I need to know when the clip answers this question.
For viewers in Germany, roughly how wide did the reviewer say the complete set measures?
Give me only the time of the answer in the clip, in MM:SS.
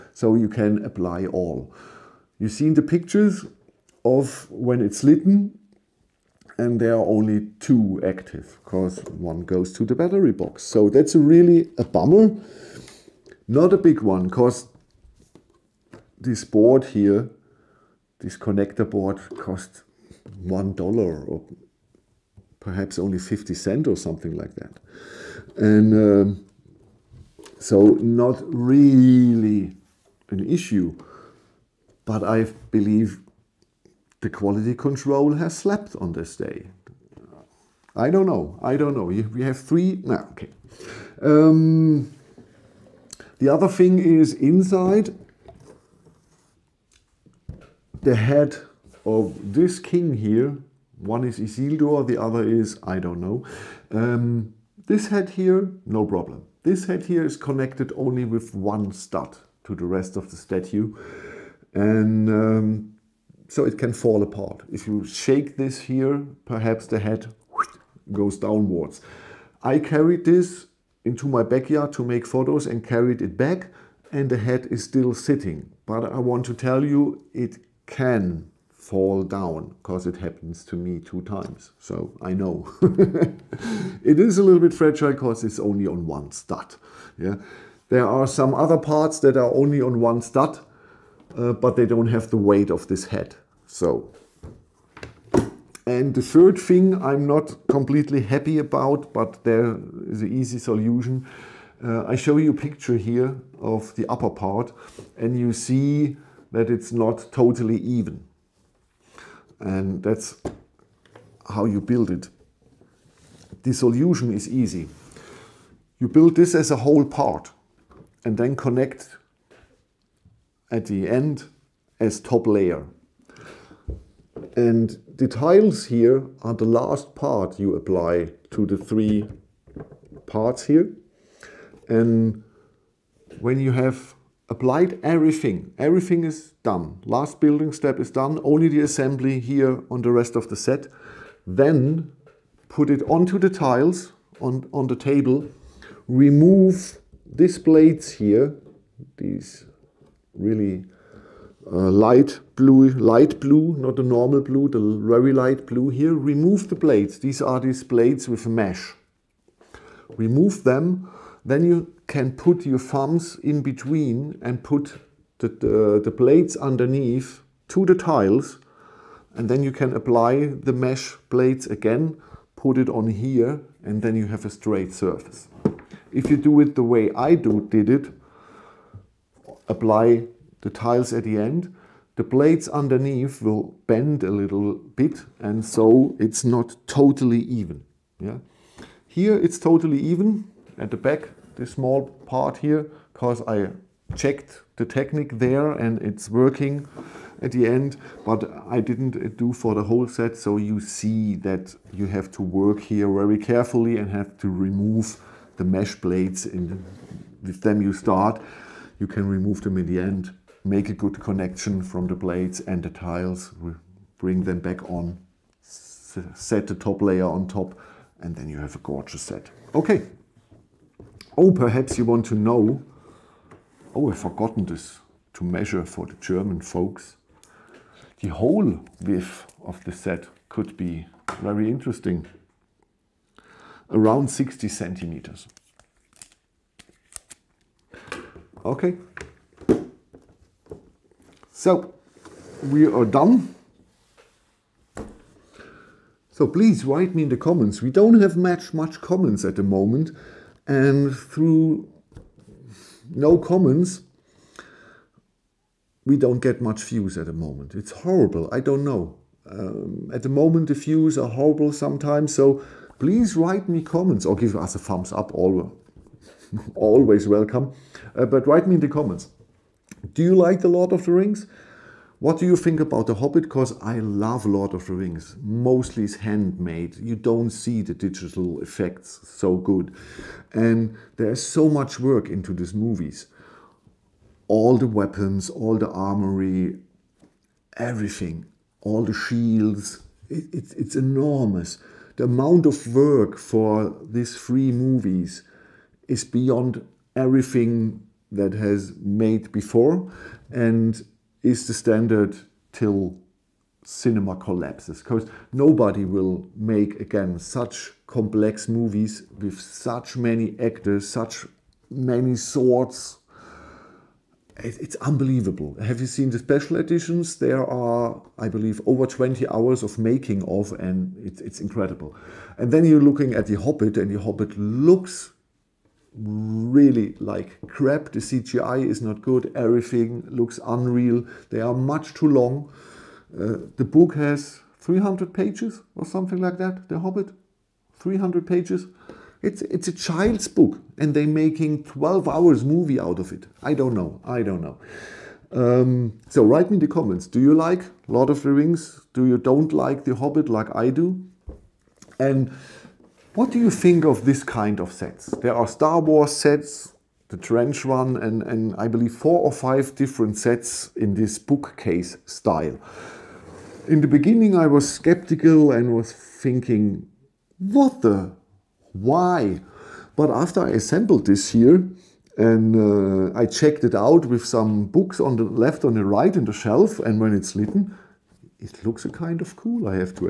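03:54.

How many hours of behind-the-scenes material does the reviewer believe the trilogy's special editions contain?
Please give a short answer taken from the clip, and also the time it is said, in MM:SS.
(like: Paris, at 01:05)
Over 20 hours, at 05:18.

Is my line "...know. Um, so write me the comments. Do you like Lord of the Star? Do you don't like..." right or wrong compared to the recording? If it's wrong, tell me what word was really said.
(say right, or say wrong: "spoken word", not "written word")
wrong: "Rings", not "Star".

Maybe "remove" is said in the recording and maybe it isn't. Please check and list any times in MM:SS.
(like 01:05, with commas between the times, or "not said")
02:26, 02:36, 02:40, 03:24, 03:29.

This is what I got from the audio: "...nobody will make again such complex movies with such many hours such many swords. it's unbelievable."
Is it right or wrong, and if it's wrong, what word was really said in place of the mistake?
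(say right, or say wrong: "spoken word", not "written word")
wrong: "actors", not "hours".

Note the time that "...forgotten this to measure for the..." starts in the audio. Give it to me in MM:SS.
03:44.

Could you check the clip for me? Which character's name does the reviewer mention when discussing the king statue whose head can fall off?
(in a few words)
Isildur.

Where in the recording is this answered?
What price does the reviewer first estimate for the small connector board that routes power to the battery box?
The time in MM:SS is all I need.
00:20.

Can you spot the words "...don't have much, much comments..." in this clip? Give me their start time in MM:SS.
04:07.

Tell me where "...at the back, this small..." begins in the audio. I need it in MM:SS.
03:10.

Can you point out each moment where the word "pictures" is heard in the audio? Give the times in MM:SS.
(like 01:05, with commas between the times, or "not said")
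00:02, 01:42.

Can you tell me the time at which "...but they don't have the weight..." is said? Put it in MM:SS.
01:31.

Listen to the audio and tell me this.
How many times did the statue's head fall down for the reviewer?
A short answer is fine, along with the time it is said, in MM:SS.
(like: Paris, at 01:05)
2, at 01:20.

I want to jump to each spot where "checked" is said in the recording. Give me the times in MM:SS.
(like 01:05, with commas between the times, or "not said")
03:14, 06:13.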